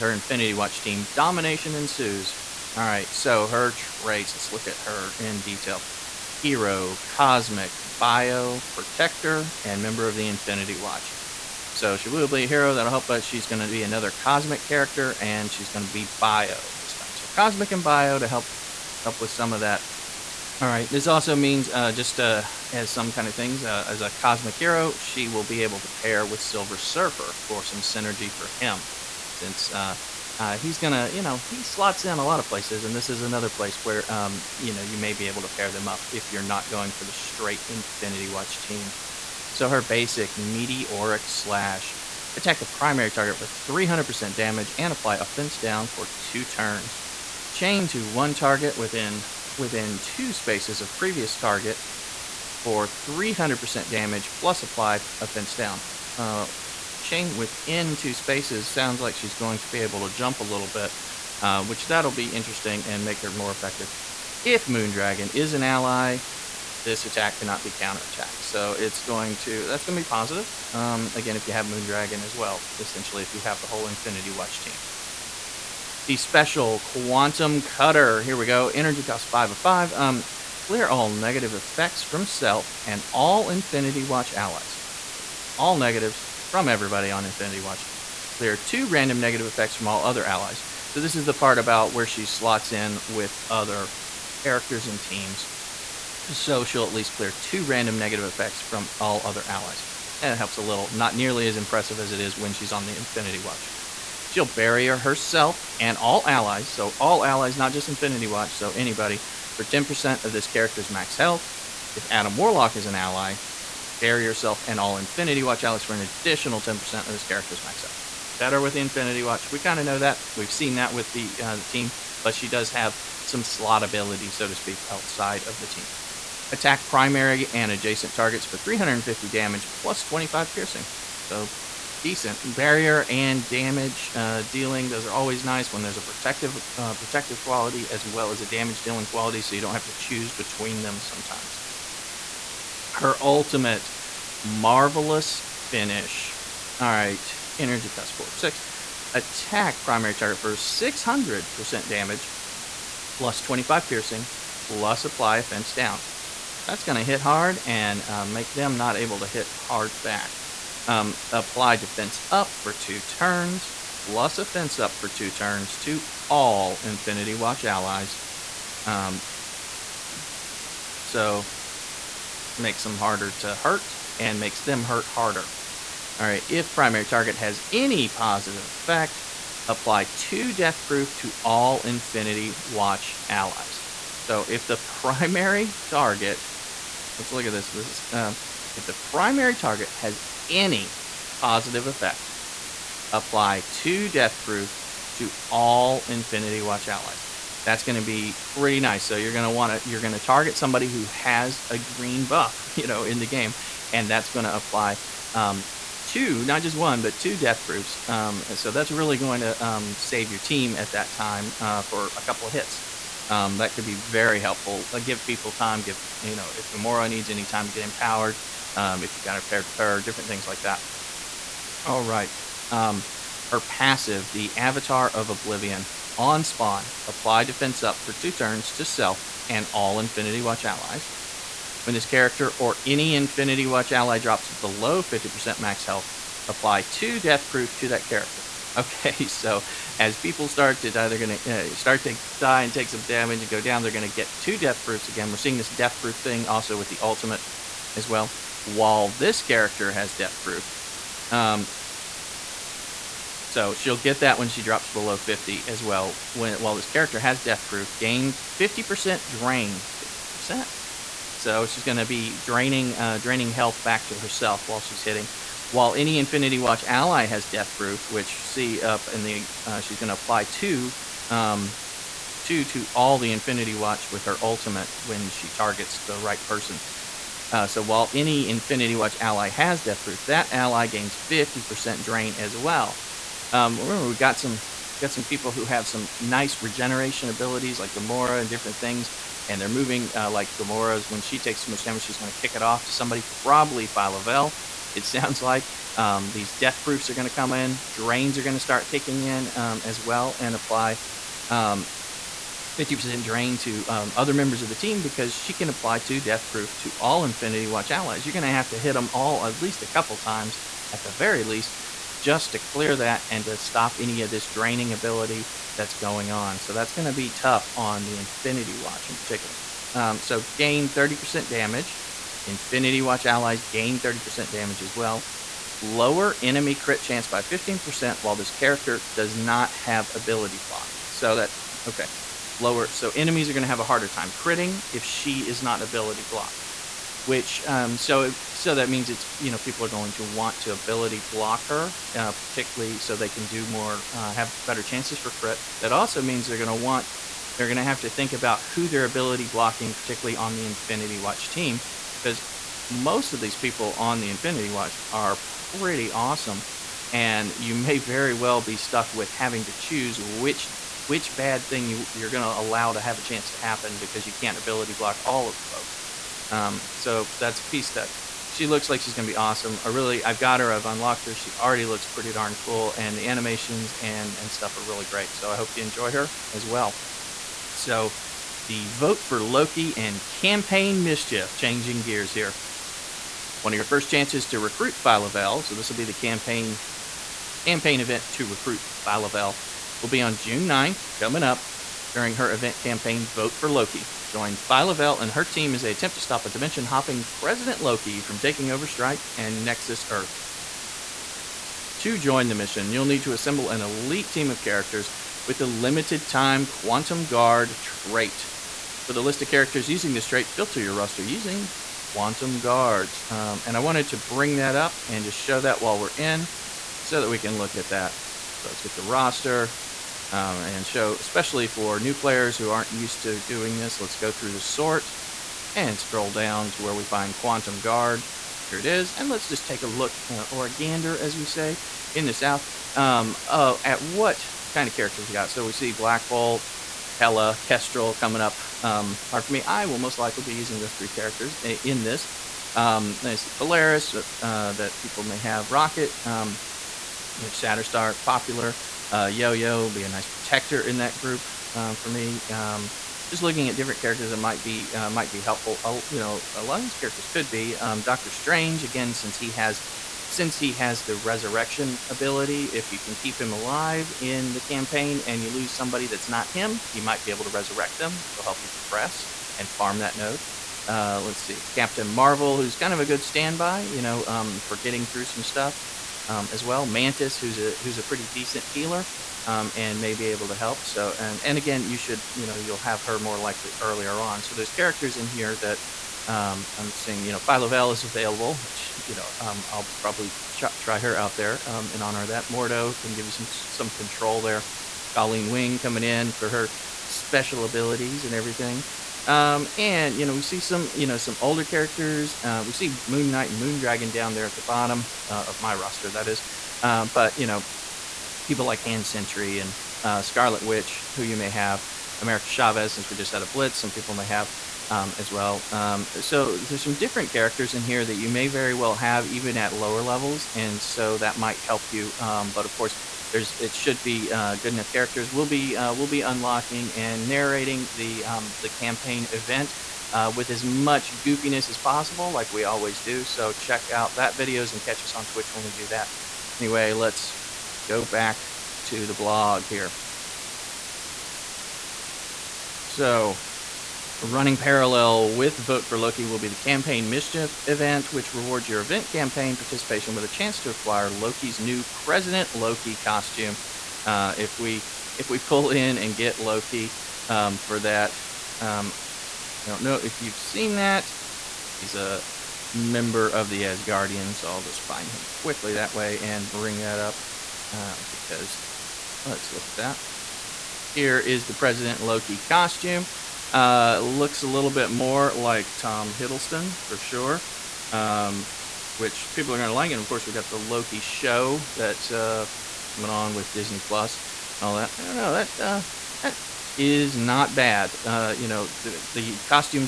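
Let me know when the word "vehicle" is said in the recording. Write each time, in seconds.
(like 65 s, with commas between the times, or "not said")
not said.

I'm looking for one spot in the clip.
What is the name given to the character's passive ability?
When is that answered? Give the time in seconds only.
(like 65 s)
224 s.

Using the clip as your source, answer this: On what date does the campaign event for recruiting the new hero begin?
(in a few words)
June 9th.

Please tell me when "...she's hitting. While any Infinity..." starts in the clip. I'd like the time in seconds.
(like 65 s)
264 s.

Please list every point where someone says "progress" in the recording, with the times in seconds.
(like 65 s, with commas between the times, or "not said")
468 s.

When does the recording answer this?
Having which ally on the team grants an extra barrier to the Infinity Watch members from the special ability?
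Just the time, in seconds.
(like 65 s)
111 s.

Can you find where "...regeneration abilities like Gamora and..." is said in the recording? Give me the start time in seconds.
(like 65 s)
286 s.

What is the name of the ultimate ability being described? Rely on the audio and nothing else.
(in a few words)
Marvelous Finish.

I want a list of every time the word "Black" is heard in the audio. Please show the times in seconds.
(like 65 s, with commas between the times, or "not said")
435 s.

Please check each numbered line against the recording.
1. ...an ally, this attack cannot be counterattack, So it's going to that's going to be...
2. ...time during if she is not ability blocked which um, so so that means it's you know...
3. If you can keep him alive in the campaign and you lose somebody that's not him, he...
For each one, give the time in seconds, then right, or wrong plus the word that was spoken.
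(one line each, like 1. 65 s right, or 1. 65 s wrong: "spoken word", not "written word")
1. 65 s right
2. 334 s wrong: "critting", not "during"
3. 462 s right.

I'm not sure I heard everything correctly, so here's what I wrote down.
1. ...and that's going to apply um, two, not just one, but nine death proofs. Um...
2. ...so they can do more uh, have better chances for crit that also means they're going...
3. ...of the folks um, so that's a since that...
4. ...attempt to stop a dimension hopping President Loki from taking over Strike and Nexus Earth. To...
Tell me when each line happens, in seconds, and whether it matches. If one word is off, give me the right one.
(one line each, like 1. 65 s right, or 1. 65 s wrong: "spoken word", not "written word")
1. 203 s wrong: "two", not "nine"
2. 342 s right
3. 365 s wrong: "piece", not "since"
4. 395 s right.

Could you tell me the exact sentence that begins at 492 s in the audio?
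Mordo can give you some some control there.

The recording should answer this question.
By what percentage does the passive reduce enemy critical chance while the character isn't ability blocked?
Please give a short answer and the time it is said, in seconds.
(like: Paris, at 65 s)
15%, at 327 s.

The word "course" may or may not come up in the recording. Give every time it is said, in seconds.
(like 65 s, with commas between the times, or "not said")
522 s, 580 s.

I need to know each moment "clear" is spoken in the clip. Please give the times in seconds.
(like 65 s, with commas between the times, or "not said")
80 s, 88 s, 97 s, 312 s.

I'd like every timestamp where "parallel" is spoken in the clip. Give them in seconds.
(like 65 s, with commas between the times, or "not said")
544 s.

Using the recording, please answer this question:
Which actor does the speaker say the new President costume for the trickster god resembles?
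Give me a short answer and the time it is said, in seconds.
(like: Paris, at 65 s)
Tom Hiddleston, at 575 s.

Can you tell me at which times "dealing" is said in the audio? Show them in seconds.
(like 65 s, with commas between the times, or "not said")
134 s, 138 s.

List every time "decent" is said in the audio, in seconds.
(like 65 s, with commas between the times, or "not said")
132 s, 478 s.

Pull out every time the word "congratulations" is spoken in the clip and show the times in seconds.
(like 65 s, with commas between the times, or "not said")
not said.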